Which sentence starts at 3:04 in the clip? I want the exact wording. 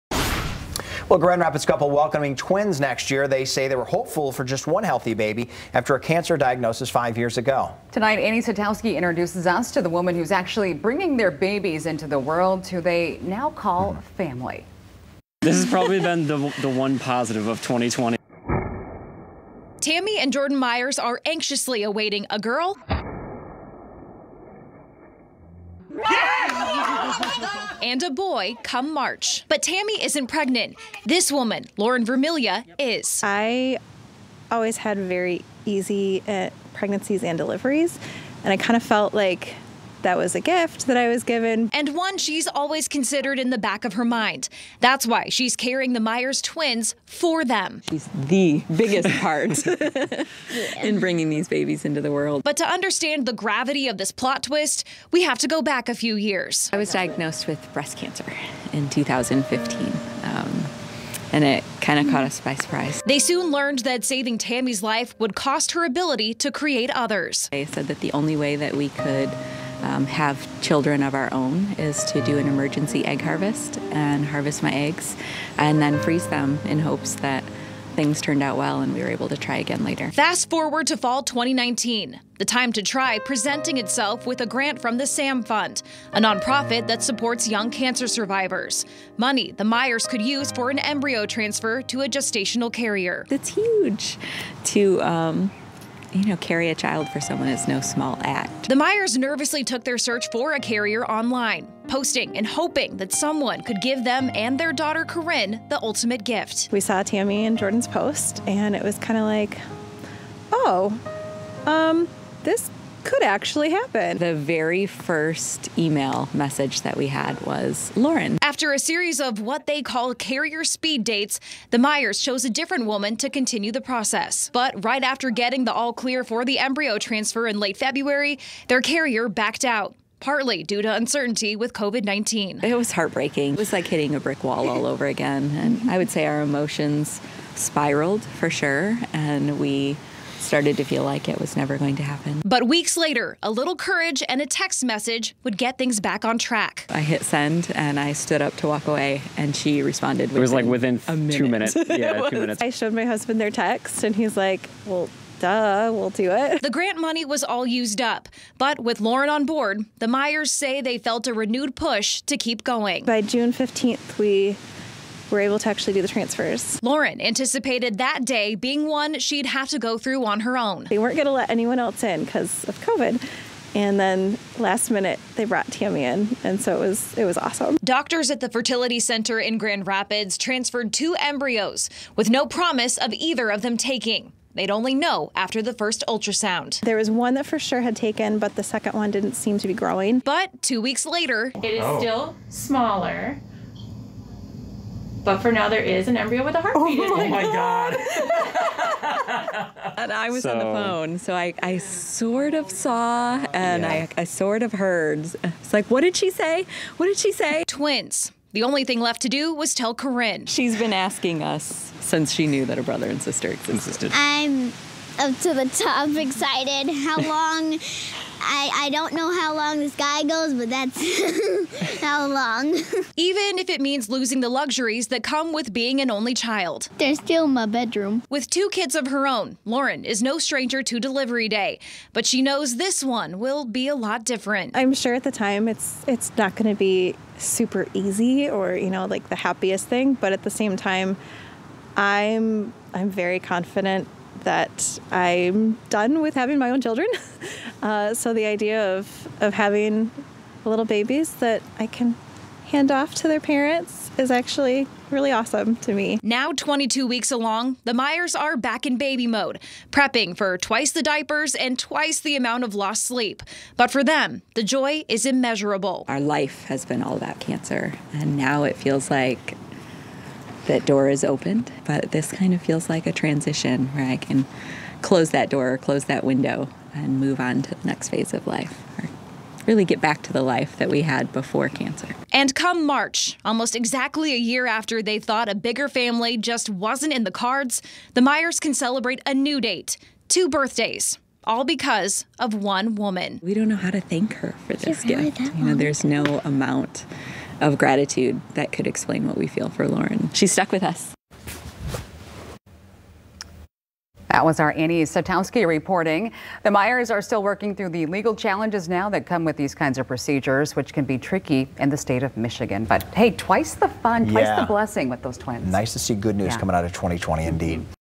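They'd only know after the first ultrasound.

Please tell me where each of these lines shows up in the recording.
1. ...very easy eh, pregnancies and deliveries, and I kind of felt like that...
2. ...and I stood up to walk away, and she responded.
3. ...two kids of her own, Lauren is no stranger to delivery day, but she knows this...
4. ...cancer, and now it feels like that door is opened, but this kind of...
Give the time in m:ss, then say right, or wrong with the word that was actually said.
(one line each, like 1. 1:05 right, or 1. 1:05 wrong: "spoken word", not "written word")
1. 0:34 right
2. 2:27 right
3. 3:48 right
4. 4:27 right.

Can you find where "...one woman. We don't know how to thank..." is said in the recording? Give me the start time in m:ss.
4:52.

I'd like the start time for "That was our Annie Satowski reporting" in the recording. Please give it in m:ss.
5:04.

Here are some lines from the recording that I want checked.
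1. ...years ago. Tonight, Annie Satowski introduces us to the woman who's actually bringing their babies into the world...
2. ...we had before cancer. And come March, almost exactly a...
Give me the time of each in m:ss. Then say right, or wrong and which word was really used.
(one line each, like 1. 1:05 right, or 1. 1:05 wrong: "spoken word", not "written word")
1. 0:07 right
2. 4:40 right.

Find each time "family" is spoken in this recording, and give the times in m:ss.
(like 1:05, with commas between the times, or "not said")
0:14, 4:45.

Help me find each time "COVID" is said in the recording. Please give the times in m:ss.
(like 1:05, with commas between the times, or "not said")
2:11, 2:52.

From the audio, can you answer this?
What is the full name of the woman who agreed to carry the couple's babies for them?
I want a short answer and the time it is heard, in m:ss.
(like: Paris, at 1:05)
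Lauren Vermilia, at 0:31.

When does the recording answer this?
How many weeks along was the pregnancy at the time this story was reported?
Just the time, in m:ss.
4:16.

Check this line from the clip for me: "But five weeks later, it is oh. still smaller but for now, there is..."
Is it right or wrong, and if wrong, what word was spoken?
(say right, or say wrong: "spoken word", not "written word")
wrong: "two", not "five".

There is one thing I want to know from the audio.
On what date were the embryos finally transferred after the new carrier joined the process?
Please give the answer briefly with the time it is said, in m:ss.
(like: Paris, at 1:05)
June 15th, at 2:43.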